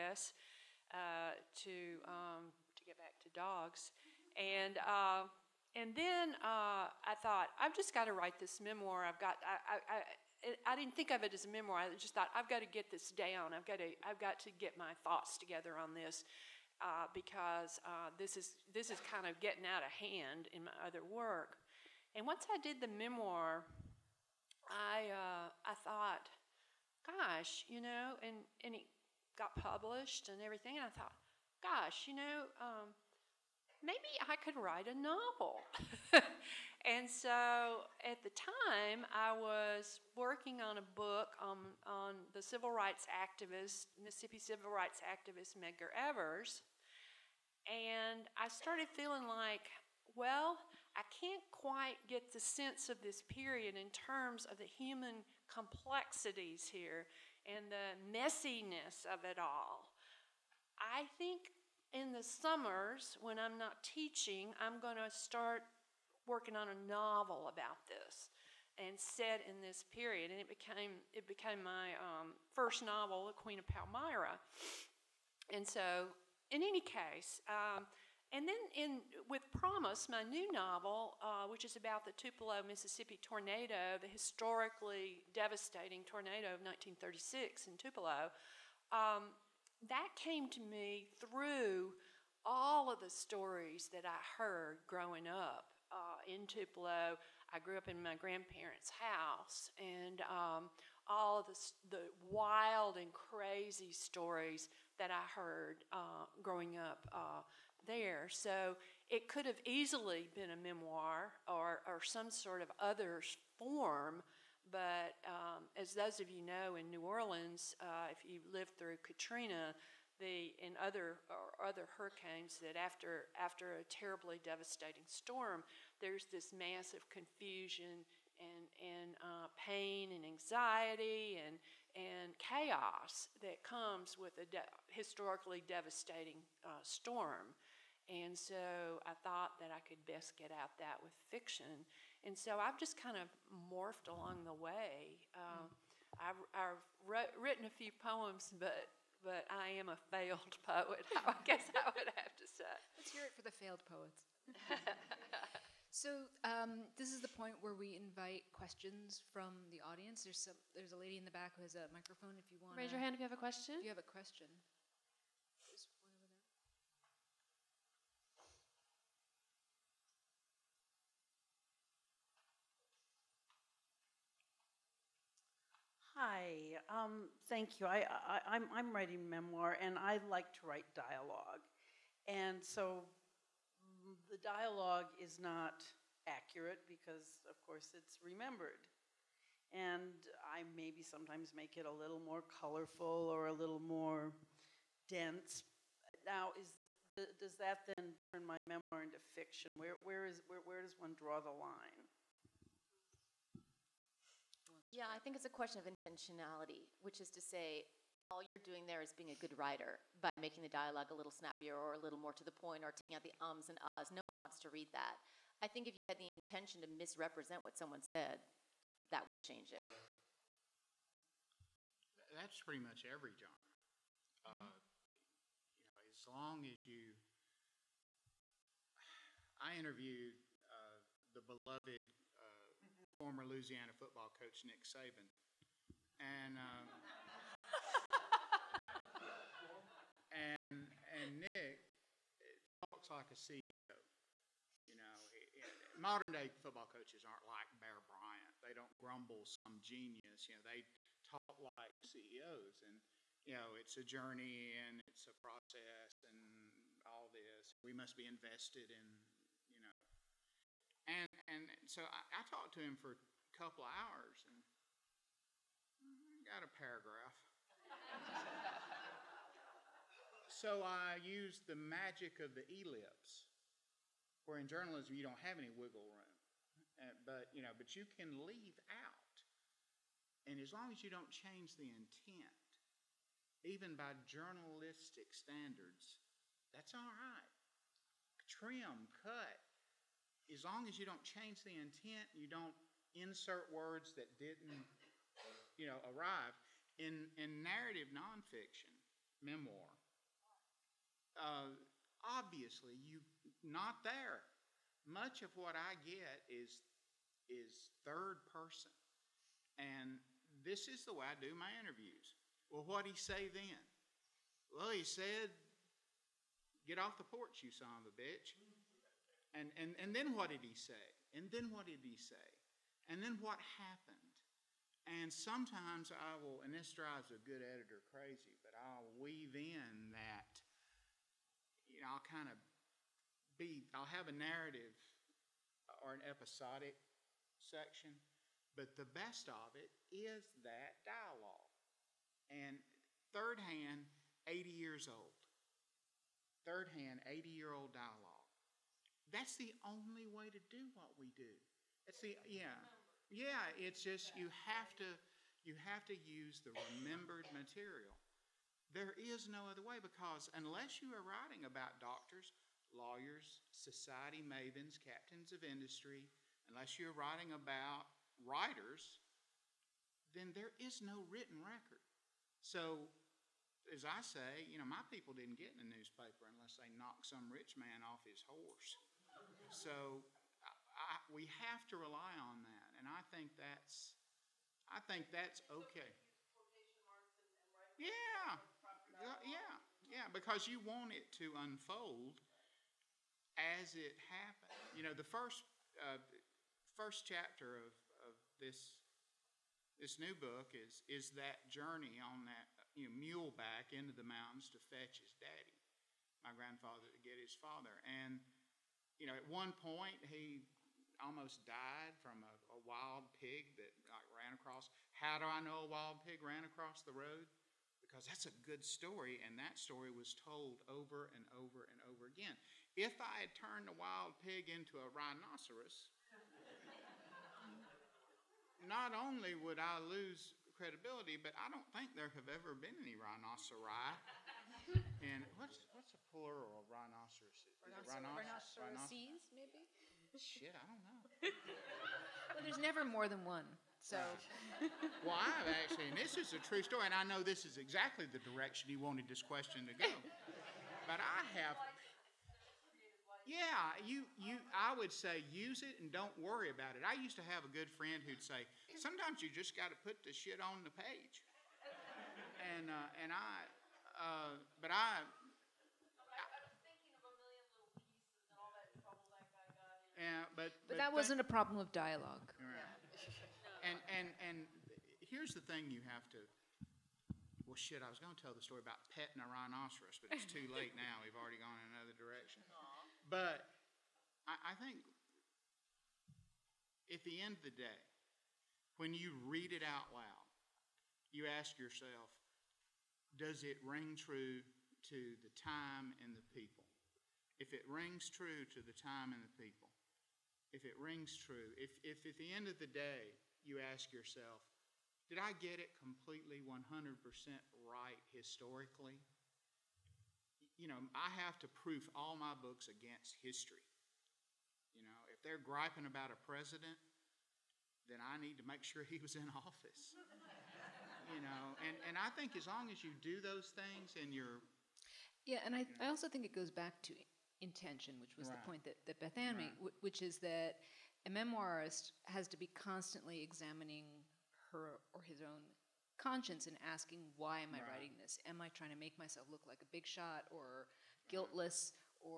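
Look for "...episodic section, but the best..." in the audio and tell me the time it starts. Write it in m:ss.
5:36.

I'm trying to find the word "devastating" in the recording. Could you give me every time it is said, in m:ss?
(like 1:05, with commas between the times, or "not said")
1:25, 2:04, 2:15.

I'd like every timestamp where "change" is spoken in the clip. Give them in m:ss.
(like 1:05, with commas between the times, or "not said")
3:39, 4:41, 4:51.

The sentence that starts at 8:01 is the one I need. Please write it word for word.
We've already gone in another direction.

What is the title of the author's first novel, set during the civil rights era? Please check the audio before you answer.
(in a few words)
The Queen of Palmyra.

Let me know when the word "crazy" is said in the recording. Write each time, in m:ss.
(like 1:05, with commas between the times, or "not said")
1:43, 5:28.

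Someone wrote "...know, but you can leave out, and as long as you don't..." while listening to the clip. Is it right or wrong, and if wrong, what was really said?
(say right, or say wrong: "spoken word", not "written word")
right.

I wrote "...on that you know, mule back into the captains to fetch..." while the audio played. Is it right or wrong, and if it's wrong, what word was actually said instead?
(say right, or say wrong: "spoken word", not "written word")
wrong: "mountains", not "captains".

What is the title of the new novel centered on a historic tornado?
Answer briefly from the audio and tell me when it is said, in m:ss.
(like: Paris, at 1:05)
Promise, at 1:19.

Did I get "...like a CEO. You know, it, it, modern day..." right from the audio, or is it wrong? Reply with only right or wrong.
right.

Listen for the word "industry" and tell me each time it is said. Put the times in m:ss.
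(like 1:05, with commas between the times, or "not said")
6:05.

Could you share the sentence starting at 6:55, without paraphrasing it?
How do I know a wild pig ran across the road?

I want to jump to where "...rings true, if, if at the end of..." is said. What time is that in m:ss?
8:20.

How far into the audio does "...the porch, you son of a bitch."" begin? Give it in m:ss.
5:17.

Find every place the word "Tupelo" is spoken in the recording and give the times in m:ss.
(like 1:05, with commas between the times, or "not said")
1:22, 1:27, 1:36.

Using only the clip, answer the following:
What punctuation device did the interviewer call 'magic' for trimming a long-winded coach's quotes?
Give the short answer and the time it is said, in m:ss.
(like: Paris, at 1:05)
ellipse, at 4:32.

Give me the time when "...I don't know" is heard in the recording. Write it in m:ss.
7:20.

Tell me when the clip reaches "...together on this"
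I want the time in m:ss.
0:15.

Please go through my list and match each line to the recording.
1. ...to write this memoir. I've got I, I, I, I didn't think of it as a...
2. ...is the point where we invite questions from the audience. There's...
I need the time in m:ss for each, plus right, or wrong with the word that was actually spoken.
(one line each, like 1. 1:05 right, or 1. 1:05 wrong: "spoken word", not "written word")
1. 0:08 right
2. 2:37 right.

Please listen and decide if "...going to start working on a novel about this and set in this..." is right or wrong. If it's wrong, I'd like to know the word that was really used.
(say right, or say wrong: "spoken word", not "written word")
right.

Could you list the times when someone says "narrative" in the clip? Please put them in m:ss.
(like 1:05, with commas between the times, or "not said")
4:57, 5:34.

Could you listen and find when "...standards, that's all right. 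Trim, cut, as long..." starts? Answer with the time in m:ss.
4:45.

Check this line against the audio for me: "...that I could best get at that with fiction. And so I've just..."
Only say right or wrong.
right.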